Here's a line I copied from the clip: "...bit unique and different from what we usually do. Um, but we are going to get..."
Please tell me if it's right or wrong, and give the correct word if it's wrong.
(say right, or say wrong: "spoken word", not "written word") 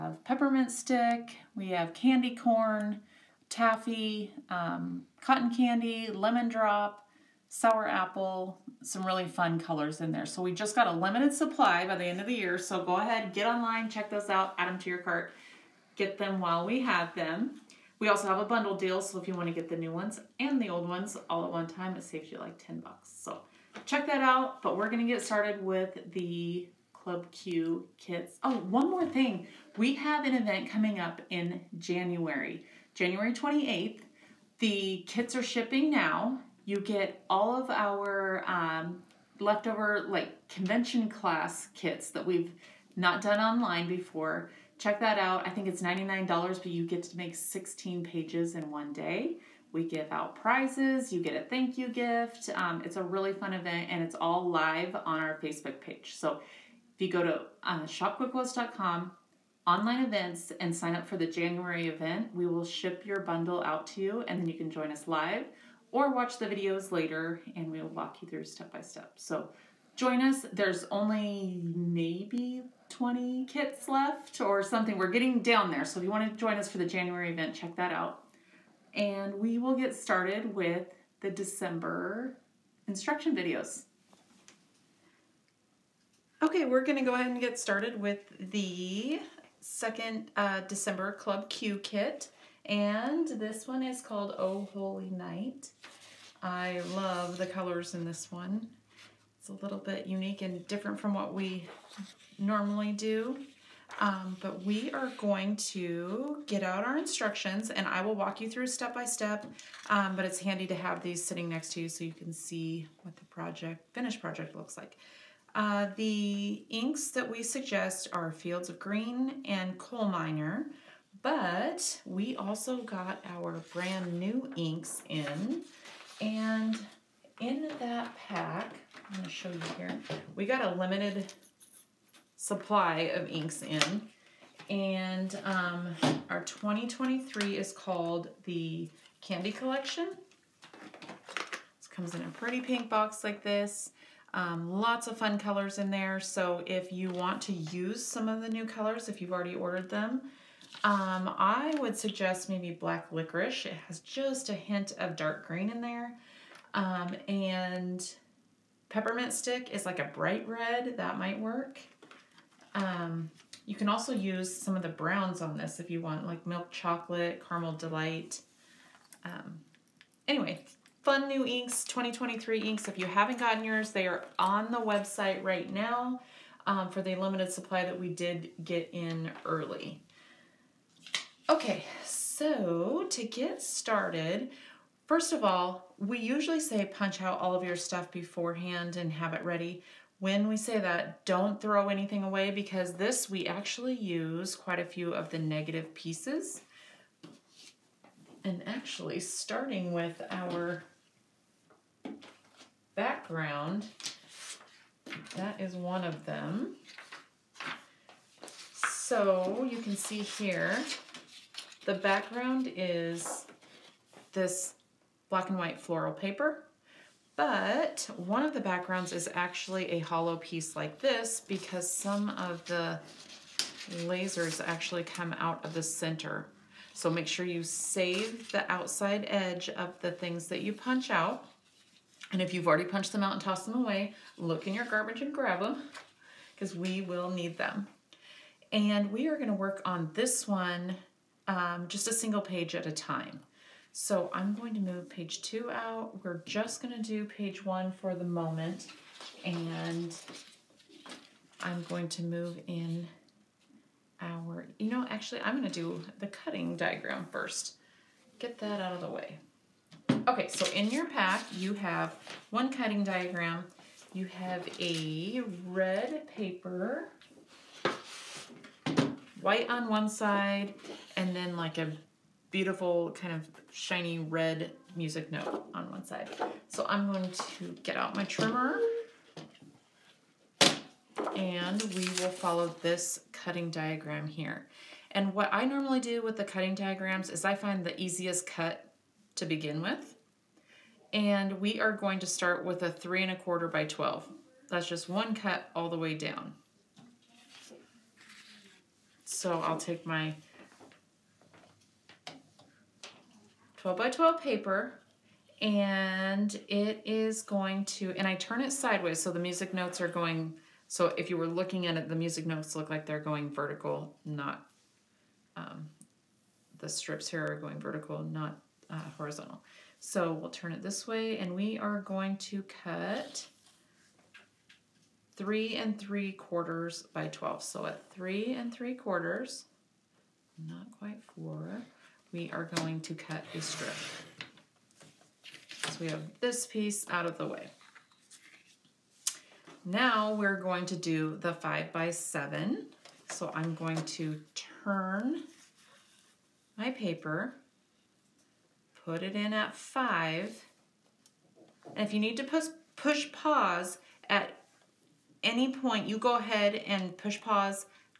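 wrong: "normally", not "usually".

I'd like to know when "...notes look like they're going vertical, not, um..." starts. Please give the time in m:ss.
5:12.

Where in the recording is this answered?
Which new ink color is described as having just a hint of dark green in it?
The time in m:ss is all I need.
2:32.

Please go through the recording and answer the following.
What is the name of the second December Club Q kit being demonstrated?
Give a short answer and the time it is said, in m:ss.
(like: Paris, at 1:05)
Oh Holy Night, at 1:34.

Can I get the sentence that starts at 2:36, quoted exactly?
Um, and peppermint stick is like a bright red.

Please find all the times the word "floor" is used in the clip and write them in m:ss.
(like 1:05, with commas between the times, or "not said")
not said.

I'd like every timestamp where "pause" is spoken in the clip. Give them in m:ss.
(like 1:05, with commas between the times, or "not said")
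5:53, 5:57.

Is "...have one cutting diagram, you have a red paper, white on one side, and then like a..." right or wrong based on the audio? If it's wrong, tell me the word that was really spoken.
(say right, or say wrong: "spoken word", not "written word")
right.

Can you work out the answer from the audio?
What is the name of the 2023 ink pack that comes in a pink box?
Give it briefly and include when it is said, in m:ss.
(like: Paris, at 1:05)
Candy Collection, at 2:18.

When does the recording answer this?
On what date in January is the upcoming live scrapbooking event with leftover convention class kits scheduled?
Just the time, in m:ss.
0:32.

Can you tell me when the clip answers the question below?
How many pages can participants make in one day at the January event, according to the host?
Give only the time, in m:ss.
0:47.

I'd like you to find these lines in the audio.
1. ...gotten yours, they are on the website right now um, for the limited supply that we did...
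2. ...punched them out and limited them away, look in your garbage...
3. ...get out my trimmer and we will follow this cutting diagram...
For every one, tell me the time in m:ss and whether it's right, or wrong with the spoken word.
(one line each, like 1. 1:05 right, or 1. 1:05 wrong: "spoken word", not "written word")
1. 2:53 right
2. 3:52 wrong: "tossed", not "limited"
3. 4:37 right.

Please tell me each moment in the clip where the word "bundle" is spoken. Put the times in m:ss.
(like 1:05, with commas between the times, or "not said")
0:18, 1:03.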